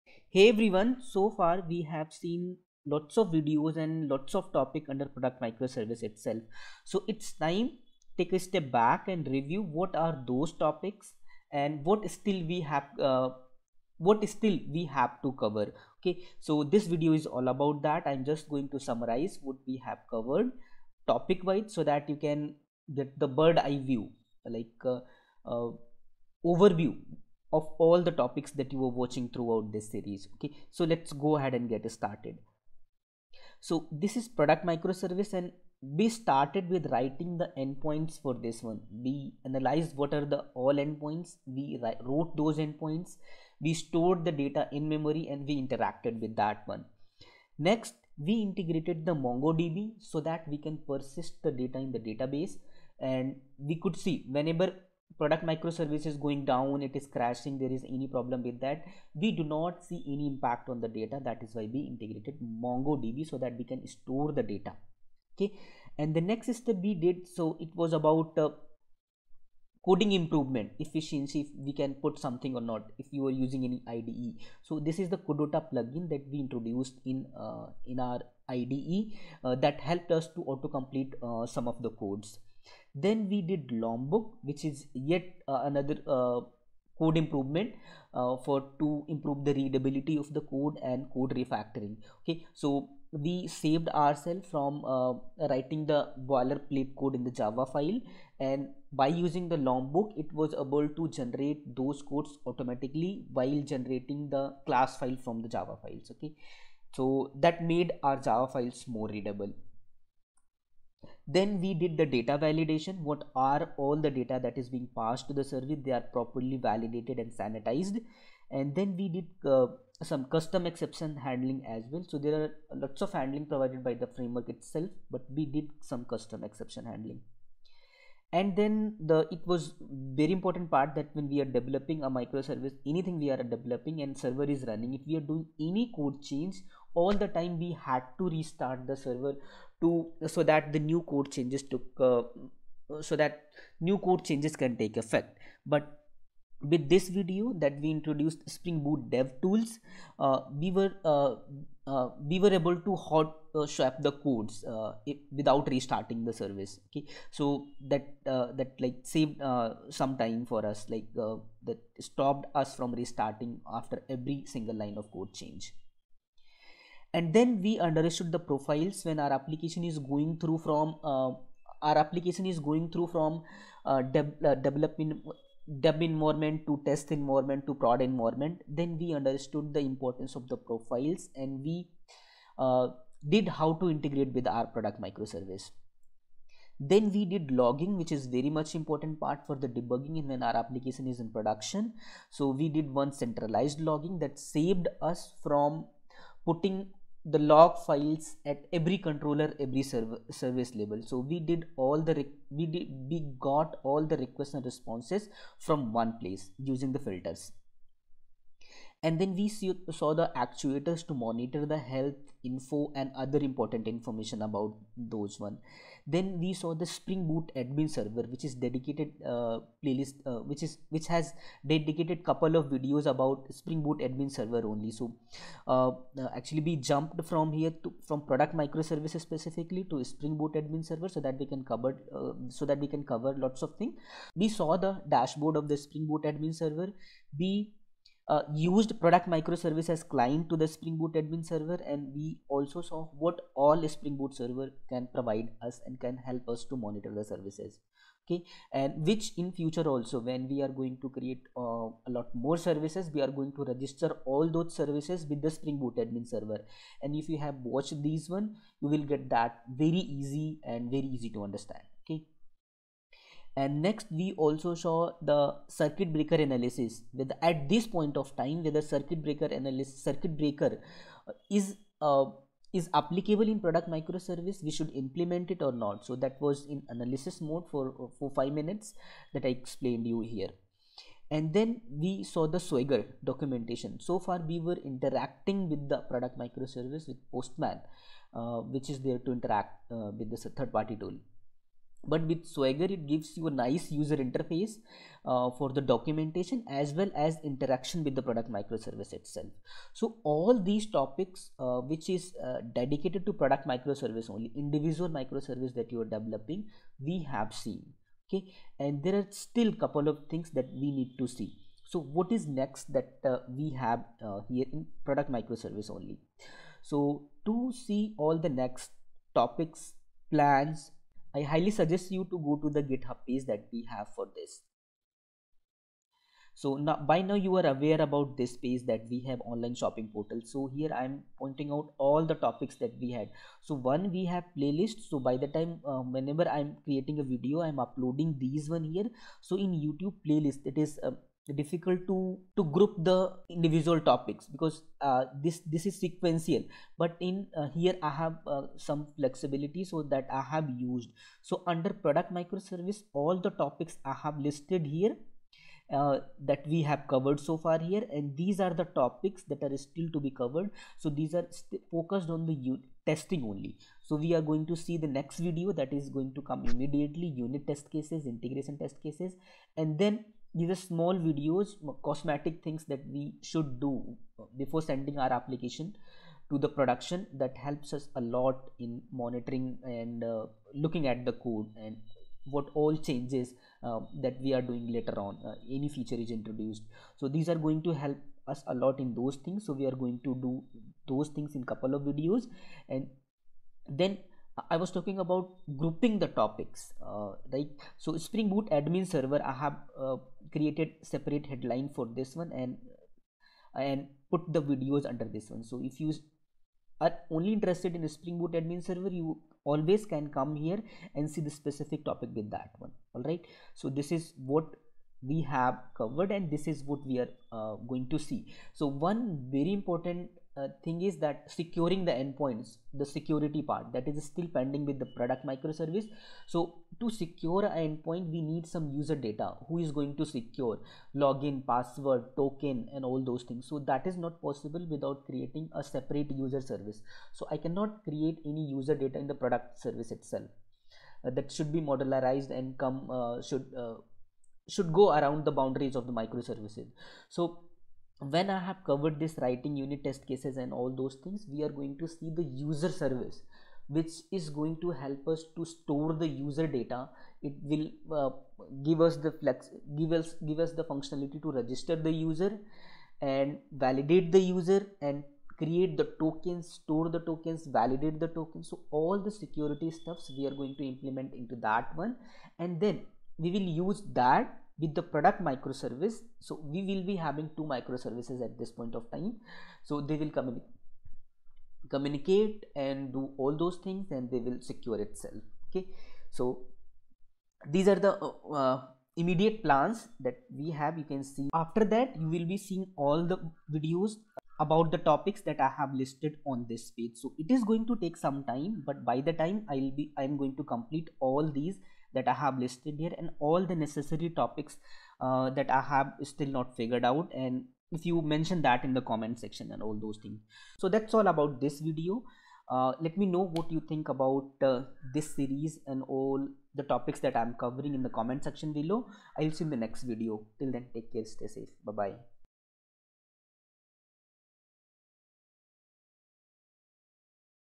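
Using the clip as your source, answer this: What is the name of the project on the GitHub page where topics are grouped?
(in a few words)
Online shopping portal.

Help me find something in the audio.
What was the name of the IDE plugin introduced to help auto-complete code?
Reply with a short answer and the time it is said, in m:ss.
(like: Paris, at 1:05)
Codota, at 1:15.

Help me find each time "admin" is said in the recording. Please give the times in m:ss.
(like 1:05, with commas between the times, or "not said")
3:37, 3:43, 3:50, 3:56, 4:01, 4:15, 6:38, 6:48.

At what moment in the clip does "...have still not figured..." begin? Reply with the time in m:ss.
8:25.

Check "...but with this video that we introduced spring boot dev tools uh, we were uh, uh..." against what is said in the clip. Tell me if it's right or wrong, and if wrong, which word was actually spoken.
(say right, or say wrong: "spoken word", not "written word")
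right.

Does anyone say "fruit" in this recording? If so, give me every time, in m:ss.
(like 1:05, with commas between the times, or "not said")
not said.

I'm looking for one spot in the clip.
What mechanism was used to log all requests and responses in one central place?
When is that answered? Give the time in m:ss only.
3:26.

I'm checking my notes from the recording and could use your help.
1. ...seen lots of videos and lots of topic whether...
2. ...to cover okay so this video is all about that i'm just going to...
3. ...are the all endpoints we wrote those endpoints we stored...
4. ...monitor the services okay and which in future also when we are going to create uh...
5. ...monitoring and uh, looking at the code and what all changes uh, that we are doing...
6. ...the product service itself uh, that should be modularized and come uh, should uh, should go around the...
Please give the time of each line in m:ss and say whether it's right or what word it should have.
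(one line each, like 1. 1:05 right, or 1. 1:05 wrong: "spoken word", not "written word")
1. 0:02 wrong: "under", not "whether"
2. 0:15 right
3. 0:40 right
4. 4:06 right
5. 6:19 right
6. 7:19 right.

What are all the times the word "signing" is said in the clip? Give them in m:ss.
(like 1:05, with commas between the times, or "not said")
not said.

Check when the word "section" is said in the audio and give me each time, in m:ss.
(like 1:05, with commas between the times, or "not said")
8:29, 8:38.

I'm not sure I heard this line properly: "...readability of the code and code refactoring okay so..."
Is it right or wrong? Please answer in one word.
right.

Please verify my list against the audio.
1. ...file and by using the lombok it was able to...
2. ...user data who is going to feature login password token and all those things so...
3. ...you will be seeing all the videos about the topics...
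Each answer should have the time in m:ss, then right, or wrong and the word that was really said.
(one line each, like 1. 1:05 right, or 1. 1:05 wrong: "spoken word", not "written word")
1. 1:37 right
2. 7:08 wrong: "secure", not "feature"
3. 8:12 right.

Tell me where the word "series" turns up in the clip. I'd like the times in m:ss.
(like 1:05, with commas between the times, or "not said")
0:29, 8:35.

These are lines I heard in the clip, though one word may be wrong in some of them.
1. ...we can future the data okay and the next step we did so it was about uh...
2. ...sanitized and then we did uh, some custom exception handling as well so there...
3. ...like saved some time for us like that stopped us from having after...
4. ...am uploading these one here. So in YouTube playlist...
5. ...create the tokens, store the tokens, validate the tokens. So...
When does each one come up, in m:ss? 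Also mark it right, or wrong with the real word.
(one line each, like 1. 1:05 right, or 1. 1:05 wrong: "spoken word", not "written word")
1. 1:03 wrong: "store", not "future"
2. 1:57 right
3. 2:38 wrong: "restarting", not "having"
4. 5:37 right
5. 7:45 right.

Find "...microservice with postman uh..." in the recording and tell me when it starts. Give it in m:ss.
4:46.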